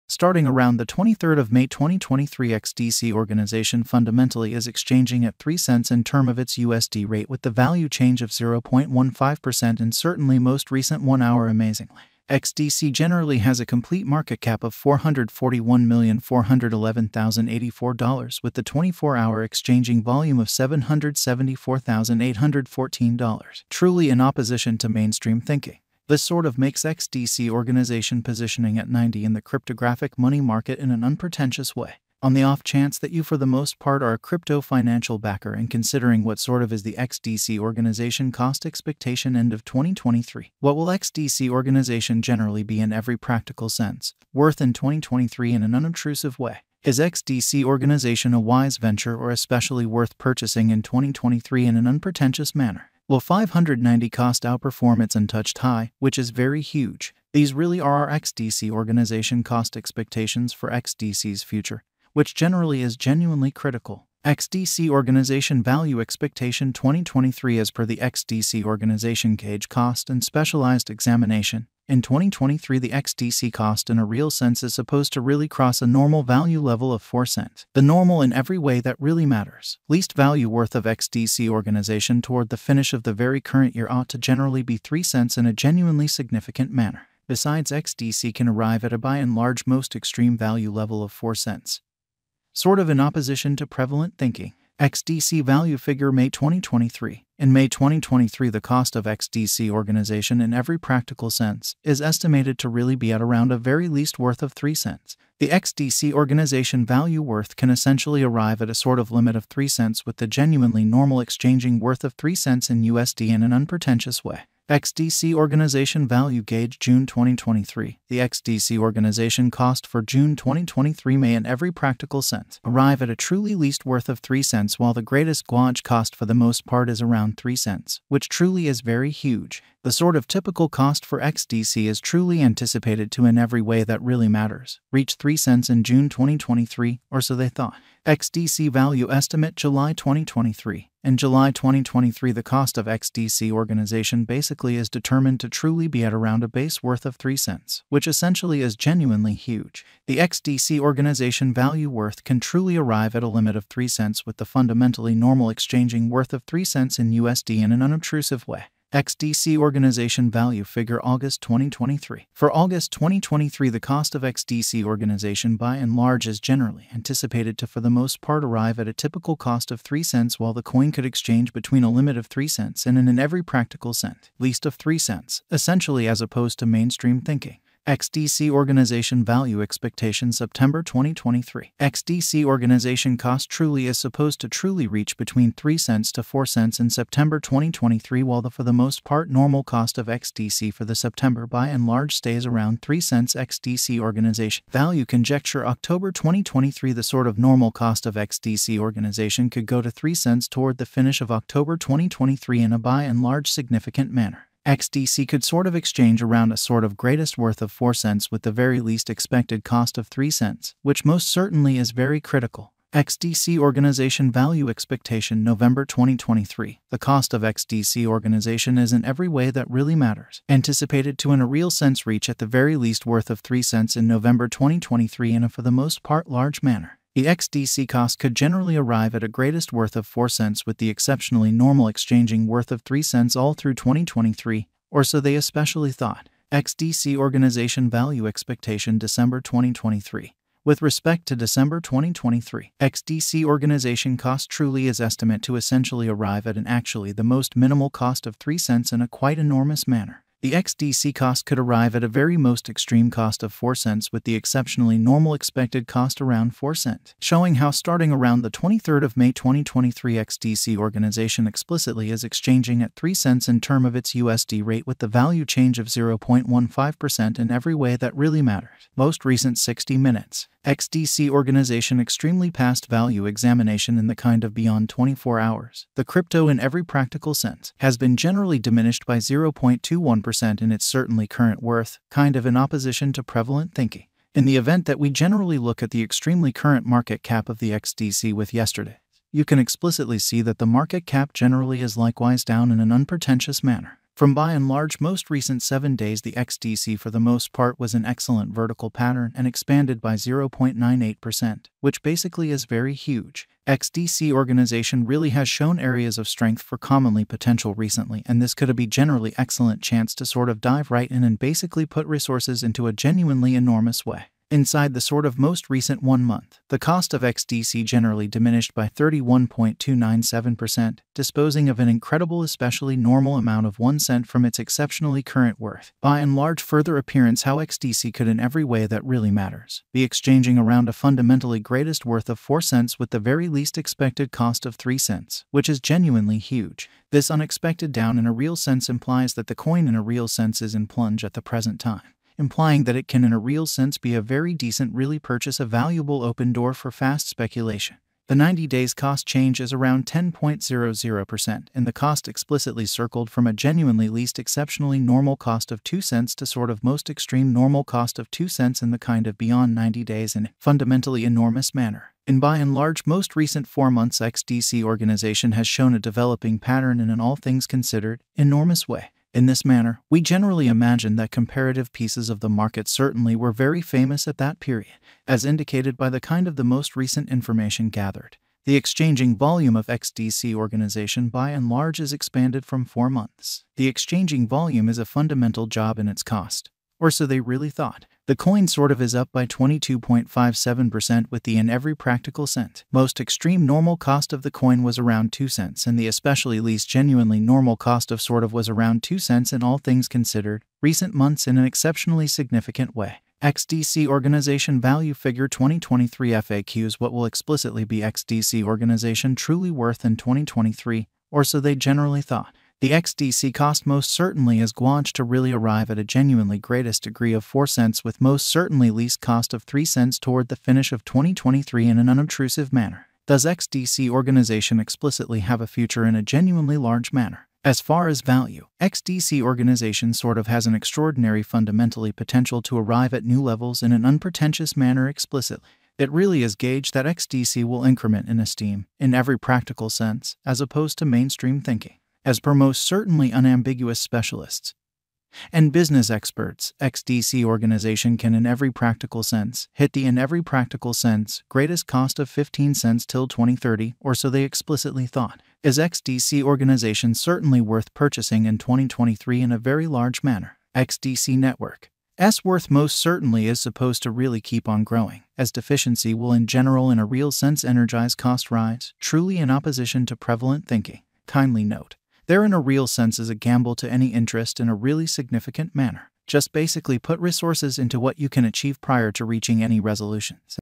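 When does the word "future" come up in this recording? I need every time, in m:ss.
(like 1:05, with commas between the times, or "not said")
1:01, 7:05.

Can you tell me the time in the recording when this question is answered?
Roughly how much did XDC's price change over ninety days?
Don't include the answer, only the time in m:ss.
5:50.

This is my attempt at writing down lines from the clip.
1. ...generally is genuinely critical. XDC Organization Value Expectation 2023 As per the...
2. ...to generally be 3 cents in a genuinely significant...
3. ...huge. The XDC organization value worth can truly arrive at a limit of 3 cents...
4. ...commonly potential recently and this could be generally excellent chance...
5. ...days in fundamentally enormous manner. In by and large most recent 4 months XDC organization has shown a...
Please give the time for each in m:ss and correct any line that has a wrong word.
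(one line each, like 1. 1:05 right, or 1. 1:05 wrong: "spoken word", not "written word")
1. 1:02 right
2. 1:24 right
3. 2:29 right
4. 5:06 right
5. 6:00 right.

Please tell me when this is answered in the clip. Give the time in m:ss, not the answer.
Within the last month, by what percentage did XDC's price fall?
5:18.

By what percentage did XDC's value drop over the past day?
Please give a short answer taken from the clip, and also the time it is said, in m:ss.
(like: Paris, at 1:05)
0.21%, at 4:39.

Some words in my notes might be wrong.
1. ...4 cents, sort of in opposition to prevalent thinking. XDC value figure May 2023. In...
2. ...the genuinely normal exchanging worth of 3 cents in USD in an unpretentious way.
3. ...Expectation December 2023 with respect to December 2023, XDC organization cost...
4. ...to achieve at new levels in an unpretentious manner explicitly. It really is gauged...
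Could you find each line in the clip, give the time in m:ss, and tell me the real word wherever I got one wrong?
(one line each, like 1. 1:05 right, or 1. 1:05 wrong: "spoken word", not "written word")
1. 1:31 right
2. 1:50 right
3. 3:58 right
4. 7:12 wrong: "arrive", not "achieve".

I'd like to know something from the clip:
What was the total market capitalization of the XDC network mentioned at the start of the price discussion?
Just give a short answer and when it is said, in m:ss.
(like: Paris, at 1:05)
$441,411,084, at 0:14.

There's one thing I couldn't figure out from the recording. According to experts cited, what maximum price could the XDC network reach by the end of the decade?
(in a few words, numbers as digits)
15 cents.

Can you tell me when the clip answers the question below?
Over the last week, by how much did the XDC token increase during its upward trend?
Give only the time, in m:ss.
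5:00.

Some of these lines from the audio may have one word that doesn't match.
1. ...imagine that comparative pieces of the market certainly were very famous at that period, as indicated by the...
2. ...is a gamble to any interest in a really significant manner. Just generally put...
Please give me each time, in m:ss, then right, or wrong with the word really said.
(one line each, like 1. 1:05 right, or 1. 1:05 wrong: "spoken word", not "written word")
1. 6:10 right
2. 7:53 wrong: "basically", not "generally".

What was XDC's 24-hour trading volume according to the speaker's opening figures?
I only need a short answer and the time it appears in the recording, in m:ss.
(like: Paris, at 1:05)
$774,814, at 0:20.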